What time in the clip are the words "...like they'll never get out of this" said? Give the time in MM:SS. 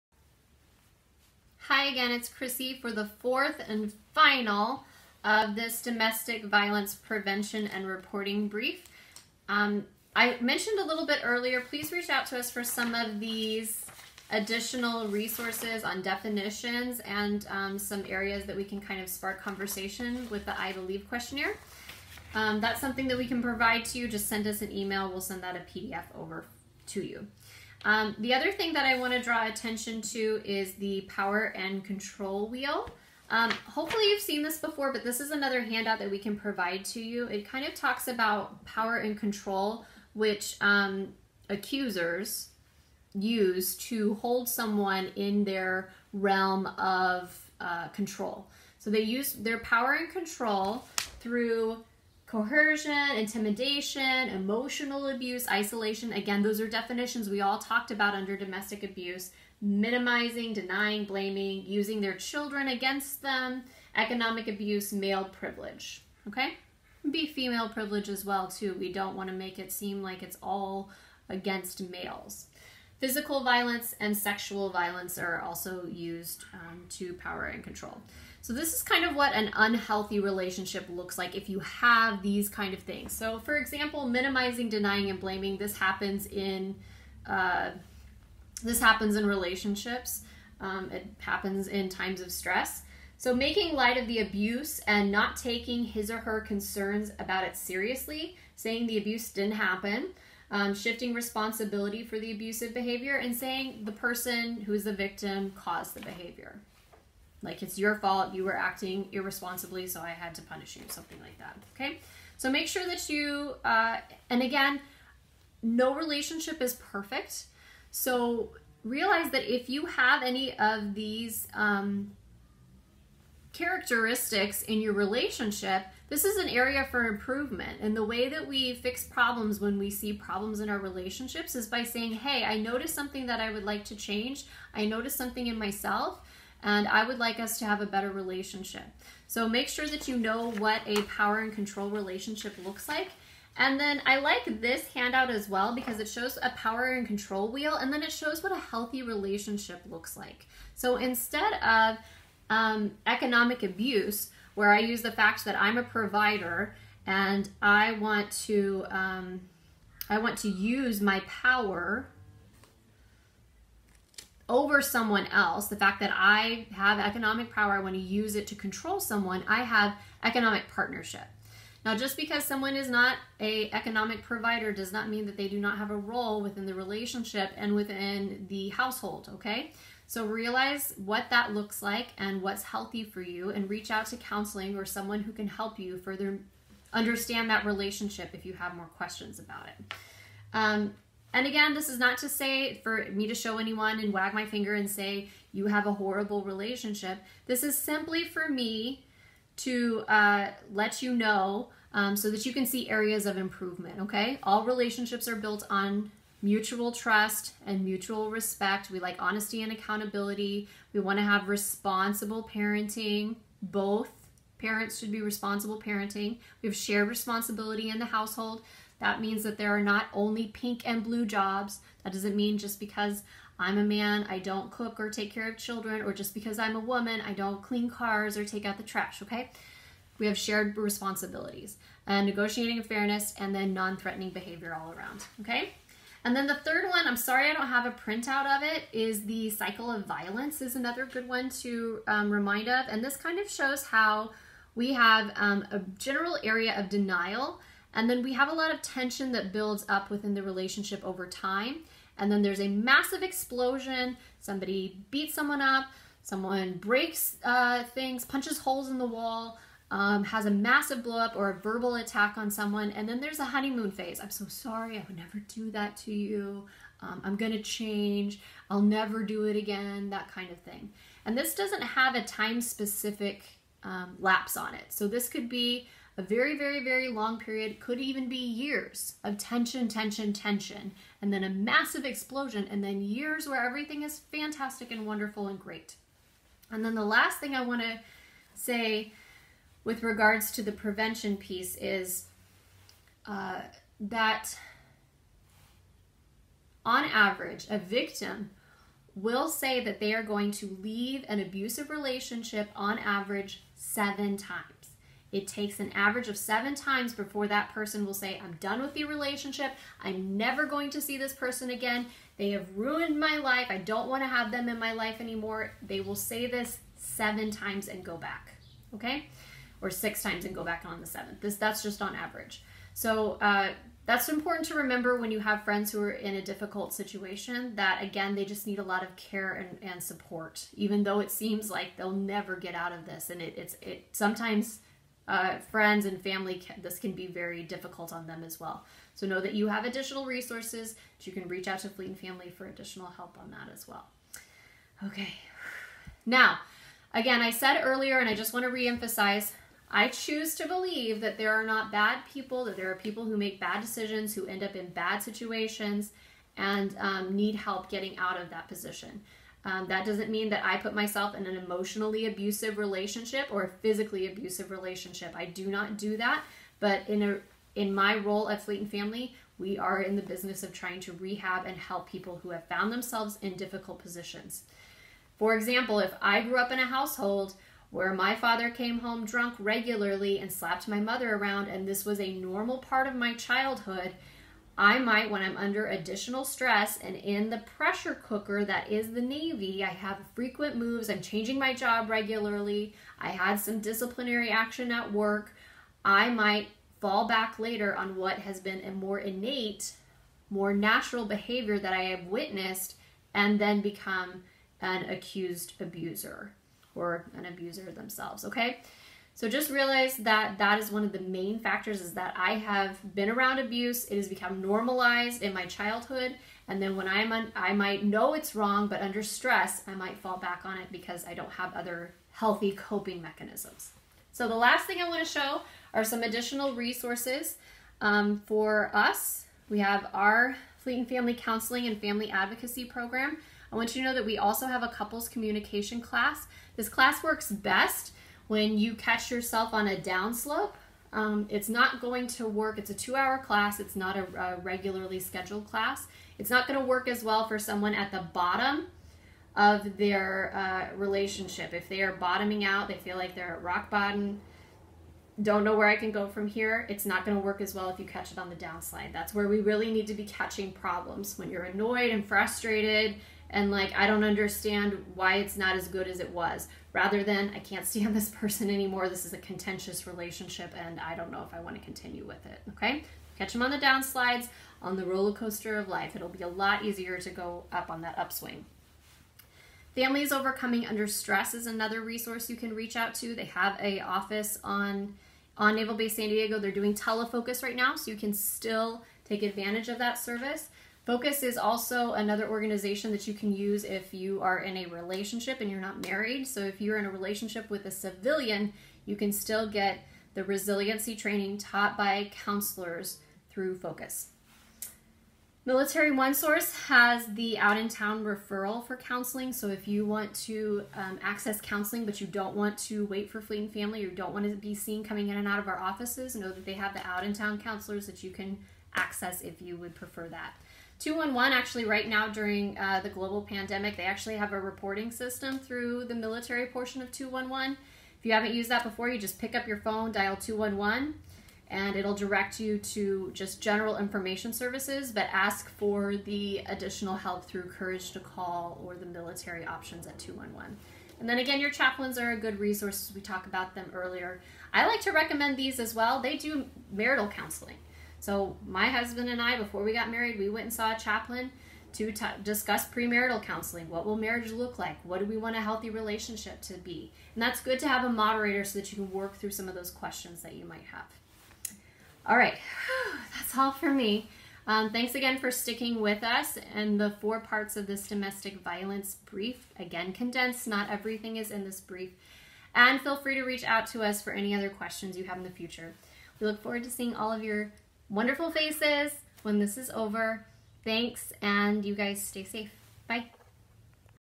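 05:31.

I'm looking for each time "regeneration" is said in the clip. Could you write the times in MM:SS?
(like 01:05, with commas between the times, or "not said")
not said.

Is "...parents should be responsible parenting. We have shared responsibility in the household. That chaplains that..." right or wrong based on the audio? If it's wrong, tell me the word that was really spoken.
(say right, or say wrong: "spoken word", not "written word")
wrong: "means", not "chaplains".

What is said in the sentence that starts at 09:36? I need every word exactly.
We look forward to seeing all of your wonderful faces when this is over.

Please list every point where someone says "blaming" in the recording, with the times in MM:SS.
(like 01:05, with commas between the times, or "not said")
01:01, 01:25.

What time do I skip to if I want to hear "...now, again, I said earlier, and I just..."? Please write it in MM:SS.
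05:46.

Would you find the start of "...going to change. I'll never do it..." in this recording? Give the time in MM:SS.
04:27.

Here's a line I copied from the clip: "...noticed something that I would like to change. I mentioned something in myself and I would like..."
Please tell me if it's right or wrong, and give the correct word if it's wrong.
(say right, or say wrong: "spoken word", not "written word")
wrong: "noticed", not "mentioned".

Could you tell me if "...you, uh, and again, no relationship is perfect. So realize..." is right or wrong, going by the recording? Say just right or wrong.
right.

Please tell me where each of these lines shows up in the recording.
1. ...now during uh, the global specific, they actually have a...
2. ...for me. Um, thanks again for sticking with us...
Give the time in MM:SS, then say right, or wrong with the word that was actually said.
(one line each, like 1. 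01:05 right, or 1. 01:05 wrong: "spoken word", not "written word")
1. 08:42 wrong: "pandemic", not "specific"
2. 09:23 right.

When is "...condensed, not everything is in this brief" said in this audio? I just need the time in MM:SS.
09:30.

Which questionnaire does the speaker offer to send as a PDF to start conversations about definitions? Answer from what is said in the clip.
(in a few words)
I Believe questionnaire.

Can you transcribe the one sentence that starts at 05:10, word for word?
I'm never going to see this person again.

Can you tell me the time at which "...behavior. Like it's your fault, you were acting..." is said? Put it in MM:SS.
01:46.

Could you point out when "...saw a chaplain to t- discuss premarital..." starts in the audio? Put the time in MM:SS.
09:10.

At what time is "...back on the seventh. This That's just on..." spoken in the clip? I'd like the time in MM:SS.
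05:20.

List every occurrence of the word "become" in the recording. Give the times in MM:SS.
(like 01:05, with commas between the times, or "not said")
06:43, 06:54.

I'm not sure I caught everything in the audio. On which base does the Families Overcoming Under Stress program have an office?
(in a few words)
Naval Base San Diego.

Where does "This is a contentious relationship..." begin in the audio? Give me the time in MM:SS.
07:49.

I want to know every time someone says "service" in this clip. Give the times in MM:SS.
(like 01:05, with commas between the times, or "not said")
08:10, 08:54.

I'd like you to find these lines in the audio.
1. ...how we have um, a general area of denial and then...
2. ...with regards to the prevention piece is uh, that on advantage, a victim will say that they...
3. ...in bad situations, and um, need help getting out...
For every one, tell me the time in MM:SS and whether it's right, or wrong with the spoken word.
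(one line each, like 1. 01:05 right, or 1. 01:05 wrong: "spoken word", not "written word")
1. 04:03 right
2. 04:49 wrong: "average", not "advantage"
3. 05:54 right.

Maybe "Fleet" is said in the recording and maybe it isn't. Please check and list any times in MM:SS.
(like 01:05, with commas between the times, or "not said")
05:41, 06:08, 07:10, 08:33.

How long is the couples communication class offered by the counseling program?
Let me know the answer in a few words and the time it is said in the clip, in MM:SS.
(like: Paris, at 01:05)
2 hours, at 07:22.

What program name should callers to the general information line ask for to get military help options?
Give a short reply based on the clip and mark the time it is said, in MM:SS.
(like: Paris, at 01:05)
Courage to Call, at 08:57.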